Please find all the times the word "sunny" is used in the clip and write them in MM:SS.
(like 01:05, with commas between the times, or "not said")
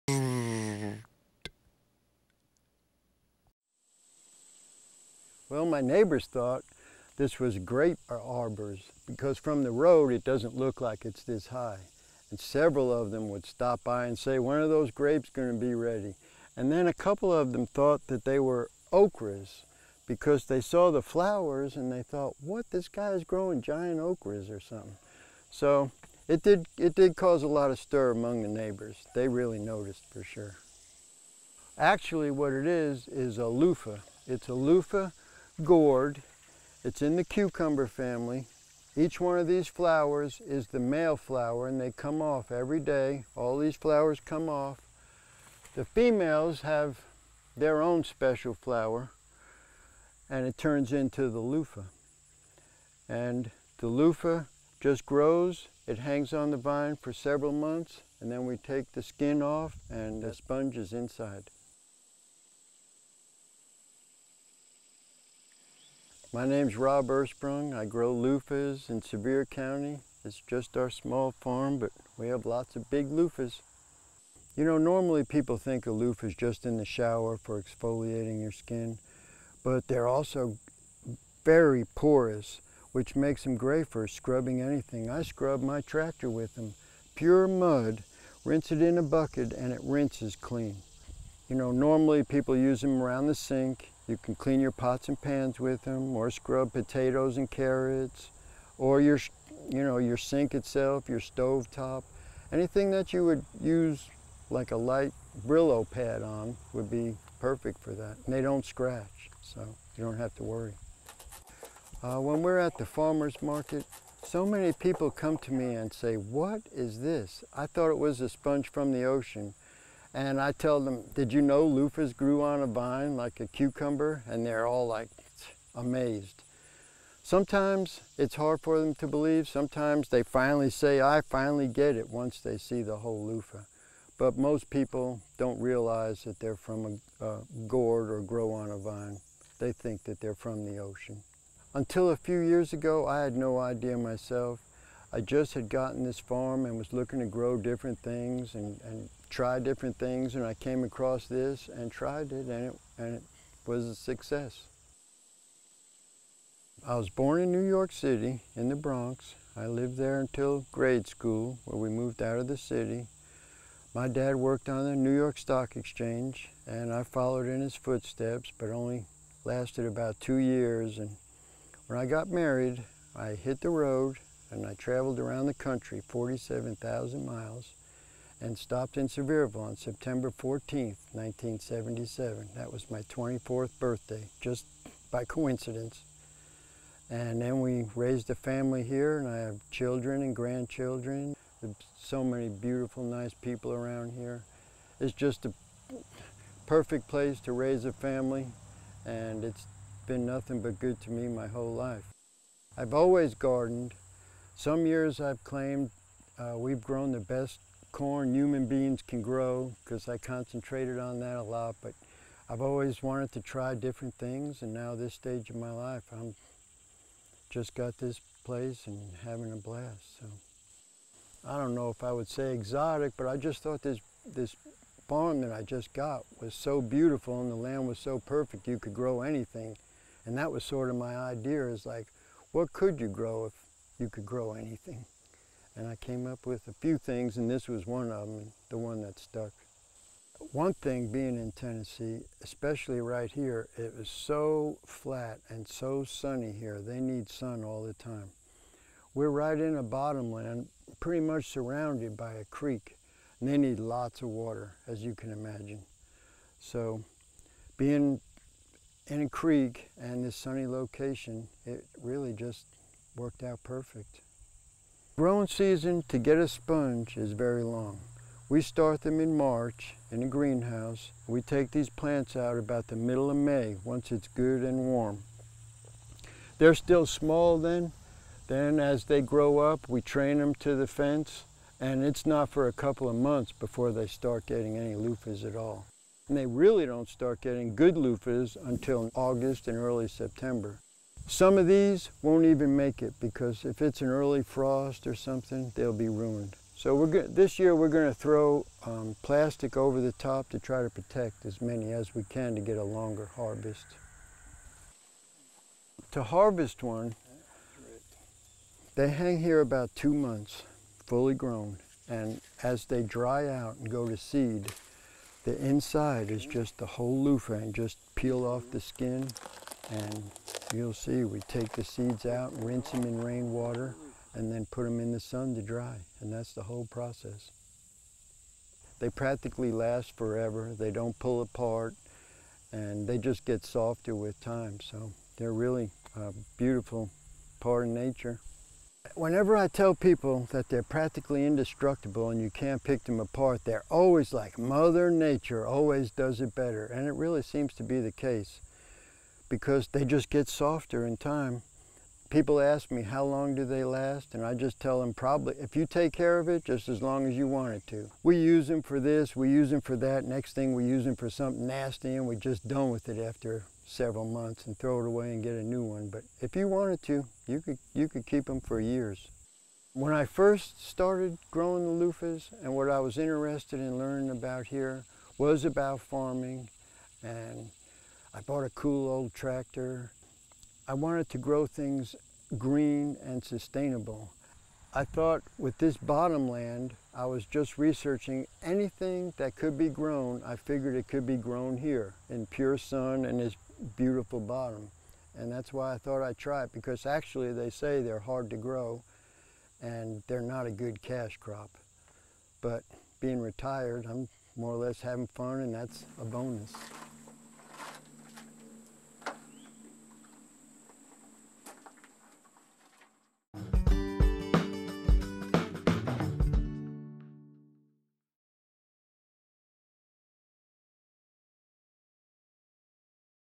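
04:06, 04:20.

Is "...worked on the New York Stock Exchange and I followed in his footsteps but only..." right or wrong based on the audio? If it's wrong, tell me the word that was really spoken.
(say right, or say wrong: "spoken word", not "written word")
right.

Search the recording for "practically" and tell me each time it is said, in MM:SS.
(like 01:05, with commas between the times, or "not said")
05:29, 05:40.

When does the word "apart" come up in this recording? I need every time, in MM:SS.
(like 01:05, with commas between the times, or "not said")
05:31, 05:43.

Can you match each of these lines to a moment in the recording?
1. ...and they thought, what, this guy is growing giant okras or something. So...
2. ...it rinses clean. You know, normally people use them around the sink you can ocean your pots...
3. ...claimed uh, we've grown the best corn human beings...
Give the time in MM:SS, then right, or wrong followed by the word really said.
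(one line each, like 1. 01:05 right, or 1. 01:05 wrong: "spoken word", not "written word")
1. 00:21 right
2. 01:29 wrong: "clean", not "ocean"
3. 03:25 right.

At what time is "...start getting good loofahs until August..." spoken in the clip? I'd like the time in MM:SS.
04:47.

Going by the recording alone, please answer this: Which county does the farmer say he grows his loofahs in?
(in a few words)
Sevier County.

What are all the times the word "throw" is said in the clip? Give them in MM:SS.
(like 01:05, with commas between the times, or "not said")
04:58, 06:04.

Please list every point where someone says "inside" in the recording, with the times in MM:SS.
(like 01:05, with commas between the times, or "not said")
01:00, 05:15.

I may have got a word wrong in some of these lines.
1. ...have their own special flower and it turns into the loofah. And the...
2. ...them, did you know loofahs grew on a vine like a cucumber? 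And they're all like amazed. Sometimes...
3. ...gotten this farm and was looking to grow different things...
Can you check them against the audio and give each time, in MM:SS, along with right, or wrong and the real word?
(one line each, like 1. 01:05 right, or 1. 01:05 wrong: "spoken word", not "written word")
1. 00:46 right
2. 02:00 right
3. 02:25 right.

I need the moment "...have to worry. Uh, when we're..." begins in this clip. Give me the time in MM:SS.
01:50.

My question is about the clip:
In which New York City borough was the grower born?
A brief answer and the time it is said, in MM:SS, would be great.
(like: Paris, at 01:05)
The Bronx, at 02:38.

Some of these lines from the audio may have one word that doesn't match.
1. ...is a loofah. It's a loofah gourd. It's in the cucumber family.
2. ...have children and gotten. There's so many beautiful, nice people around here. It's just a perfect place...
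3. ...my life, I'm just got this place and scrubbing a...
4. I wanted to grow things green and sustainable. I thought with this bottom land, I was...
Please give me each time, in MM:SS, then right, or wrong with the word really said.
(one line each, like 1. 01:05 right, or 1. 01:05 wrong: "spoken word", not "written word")
1. 00:33 right
2. 03:09 wrong: "grandchildren", not "gotten"
3. 03:35 wrong: "having", not "scrubbing"
4. 06:20 right.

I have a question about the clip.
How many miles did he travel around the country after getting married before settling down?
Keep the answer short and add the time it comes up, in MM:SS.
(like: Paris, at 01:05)
47,000, at 02:56.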